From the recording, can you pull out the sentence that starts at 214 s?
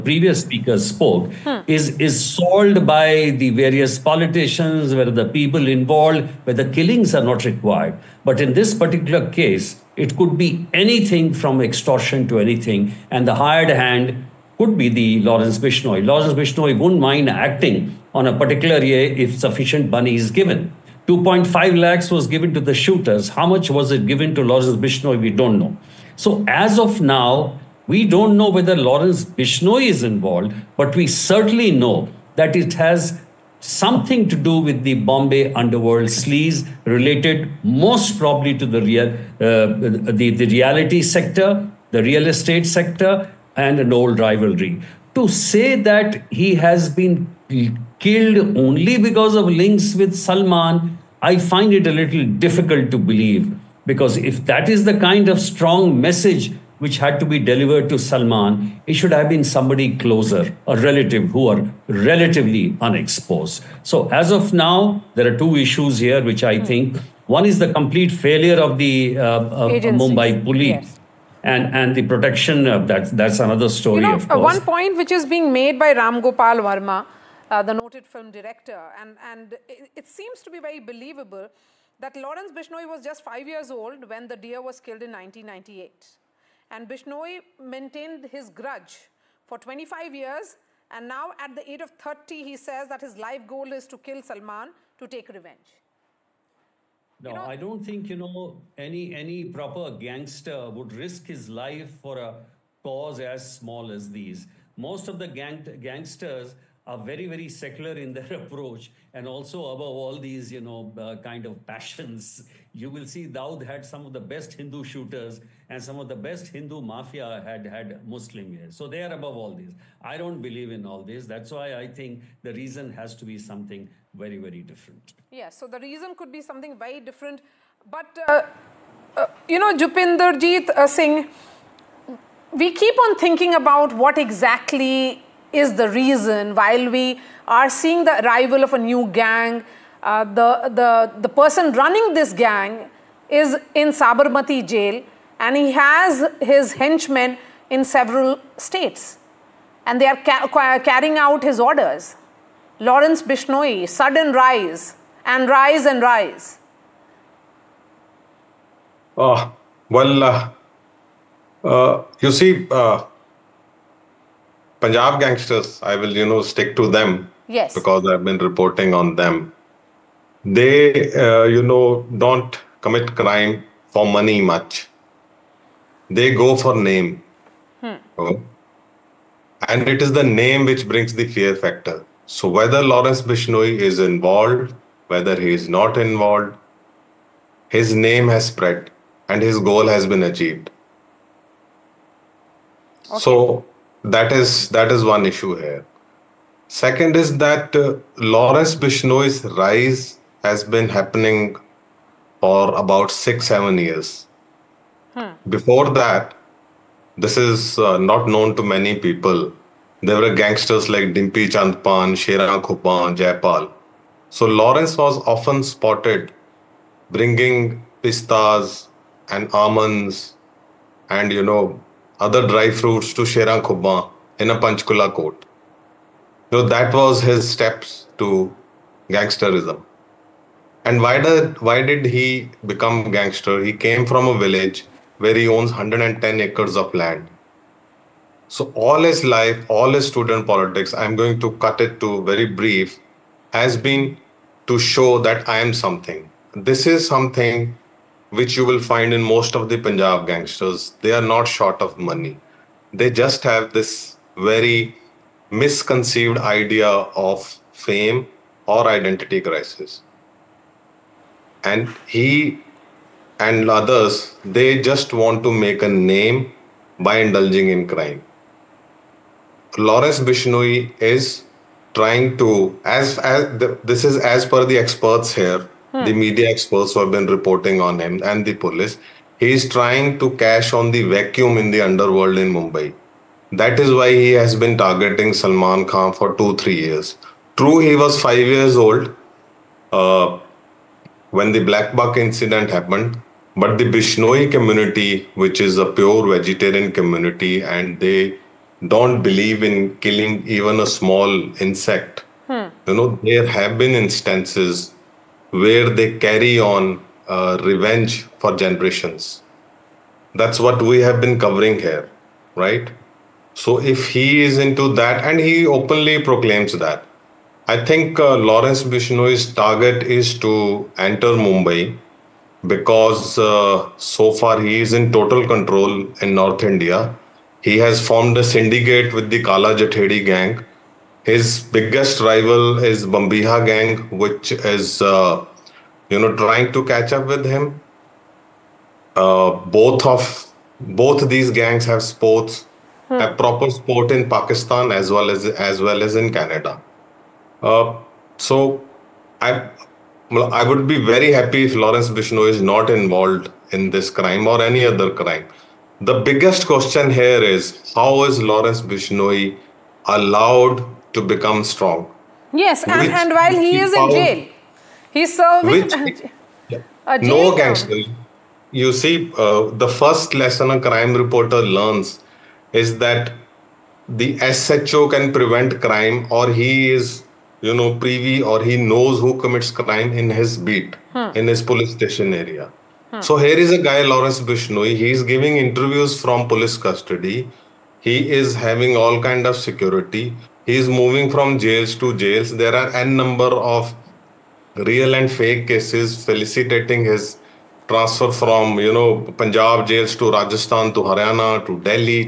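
So Lawrence was often spotted bringing pistas and almonds and you know other dry fruits to Sheran Khubma in a Panchkula court.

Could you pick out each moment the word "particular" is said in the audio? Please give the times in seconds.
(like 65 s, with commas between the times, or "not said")
8 s, 18 s.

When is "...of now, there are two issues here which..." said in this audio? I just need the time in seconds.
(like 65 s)
64 s.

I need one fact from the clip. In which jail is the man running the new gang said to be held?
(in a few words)
Sabarmati jail.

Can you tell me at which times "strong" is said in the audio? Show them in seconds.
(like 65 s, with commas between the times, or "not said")
55 s, 361 s.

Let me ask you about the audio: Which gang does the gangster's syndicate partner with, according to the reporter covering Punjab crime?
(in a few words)
Kala Jathedi gang.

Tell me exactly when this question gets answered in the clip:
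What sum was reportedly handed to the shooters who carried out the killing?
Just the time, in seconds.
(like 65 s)
21 s.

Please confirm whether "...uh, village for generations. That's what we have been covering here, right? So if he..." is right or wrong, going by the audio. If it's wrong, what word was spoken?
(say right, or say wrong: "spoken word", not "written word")
wrong: "revenge", not "village".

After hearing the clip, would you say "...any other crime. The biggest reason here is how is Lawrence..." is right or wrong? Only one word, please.
wrong.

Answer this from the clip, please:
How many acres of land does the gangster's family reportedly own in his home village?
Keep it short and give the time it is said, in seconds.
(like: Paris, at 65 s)
110 acres, at 235 s.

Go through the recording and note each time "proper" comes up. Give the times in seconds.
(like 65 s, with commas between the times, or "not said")
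99 s, 343 s.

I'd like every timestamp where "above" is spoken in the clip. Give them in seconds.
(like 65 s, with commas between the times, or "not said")
109 s, 119 s.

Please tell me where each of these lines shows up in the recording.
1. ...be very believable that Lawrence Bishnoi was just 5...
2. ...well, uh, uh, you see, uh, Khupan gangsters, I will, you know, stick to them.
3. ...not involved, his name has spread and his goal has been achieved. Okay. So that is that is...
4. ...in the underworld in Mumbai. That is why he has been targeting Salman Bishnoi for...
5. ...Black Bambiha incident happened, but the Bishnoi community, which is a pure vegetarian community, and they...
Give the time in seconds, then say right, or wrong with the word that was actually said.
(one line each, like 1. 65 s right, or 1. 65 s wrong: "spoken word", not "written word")
1. 80 s right
2. 159 s wrong: "Punjab", not "Khupan"
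3. 185 s right
4. 281 s wrong: "Khan", not "Bishnoi"
5. 291 s wrong: "Buck", not "Bambiha".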